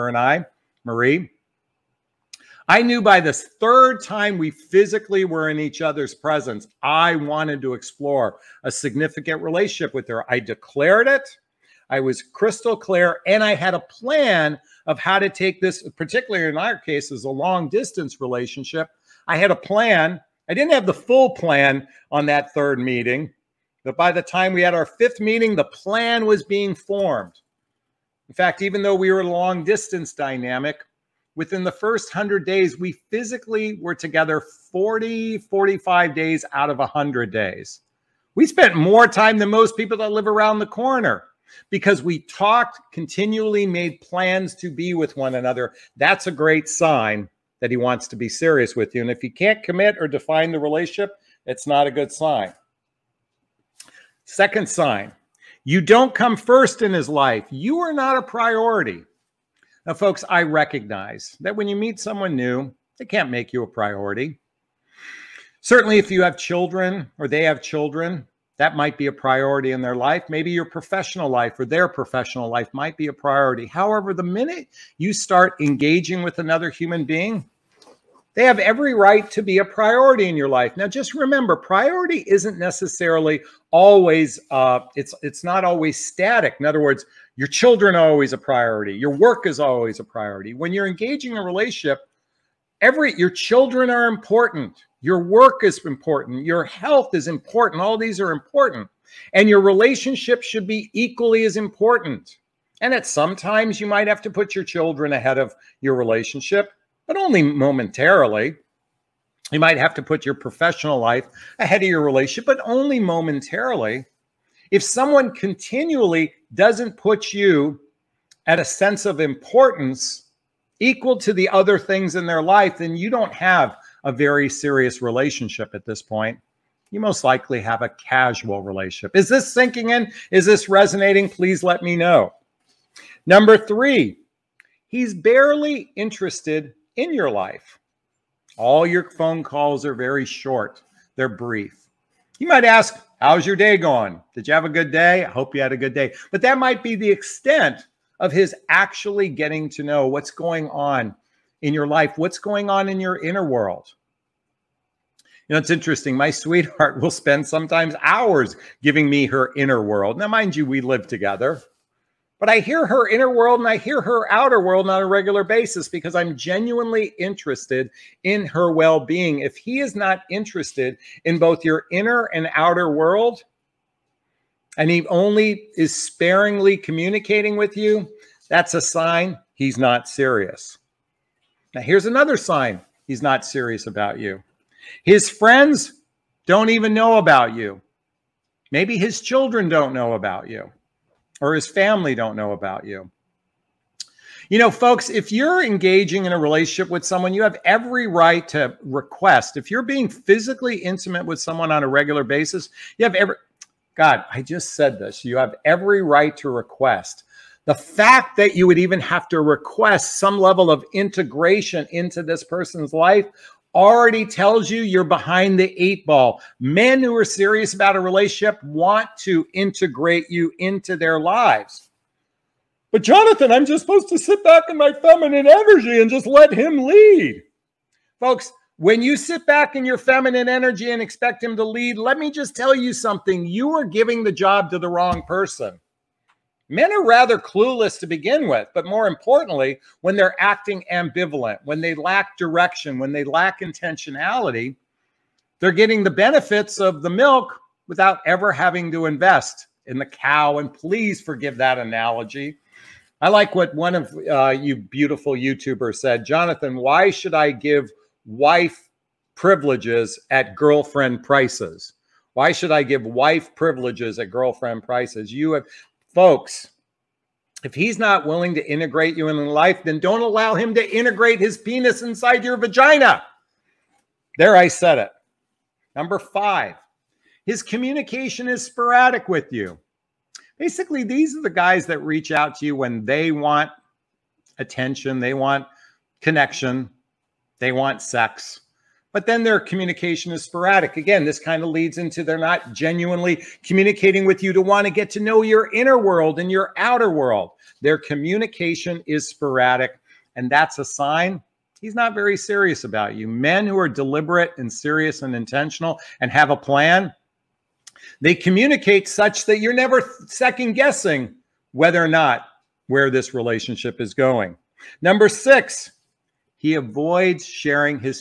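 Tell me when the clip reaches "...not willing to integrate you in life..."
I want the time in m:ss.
4:27.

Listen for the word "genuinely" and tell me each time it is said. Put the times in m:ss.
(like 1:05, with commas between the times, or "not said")
2:46, 4:52.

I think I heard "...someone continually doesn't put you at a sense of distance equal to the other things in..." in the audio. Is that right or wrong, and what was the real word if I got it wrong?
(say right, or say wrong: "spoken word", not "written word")
wrong: "importance", not "distance".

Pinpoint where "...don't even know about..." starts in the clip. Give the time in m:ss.
3:06.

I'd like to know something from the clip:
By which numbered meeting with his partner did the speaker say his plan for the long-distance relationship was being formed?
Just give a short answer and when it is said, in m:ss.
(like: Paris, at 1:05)
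fifth, at 0:24.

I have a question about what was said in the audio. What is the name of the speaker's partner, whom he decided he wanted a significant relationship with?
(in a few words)
Marie.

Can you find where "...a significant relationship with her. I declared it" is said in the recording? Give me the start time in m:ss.
0:08.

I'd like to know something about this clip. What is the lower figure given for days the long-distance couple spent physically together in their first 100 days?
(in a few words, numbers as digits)
40.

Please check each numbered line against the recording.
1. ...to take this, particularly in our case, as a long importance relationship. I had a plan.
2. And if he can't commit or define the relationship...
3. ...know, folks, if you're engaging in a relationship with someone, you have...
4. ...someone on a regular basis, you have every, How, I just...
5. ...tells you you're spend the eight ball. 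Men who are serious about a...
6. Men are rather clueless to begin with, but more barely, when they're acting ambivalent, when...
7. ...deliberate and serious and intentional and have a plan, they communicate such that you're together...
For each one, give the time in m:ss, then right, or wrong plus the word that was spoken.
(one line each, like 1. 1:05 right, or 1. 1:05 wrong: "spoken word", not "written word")
1. 0:15 wrong: "distance", not "importance"
2. 0:49 right
3. 3:14 right
4. 3:21 wrong: "God", not "How"
5. 3:34 wrong: "behind", not "spend"
6. 3:56 wrong: "importantly", not "barely"
7. 5:03 wrong: "never", not "together".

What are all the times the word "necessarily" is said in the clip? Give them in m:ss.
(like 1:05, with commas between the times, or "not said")
1:22.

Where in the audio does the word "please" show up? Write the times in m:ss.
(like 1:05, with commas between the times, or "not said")
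2:11, 4:10.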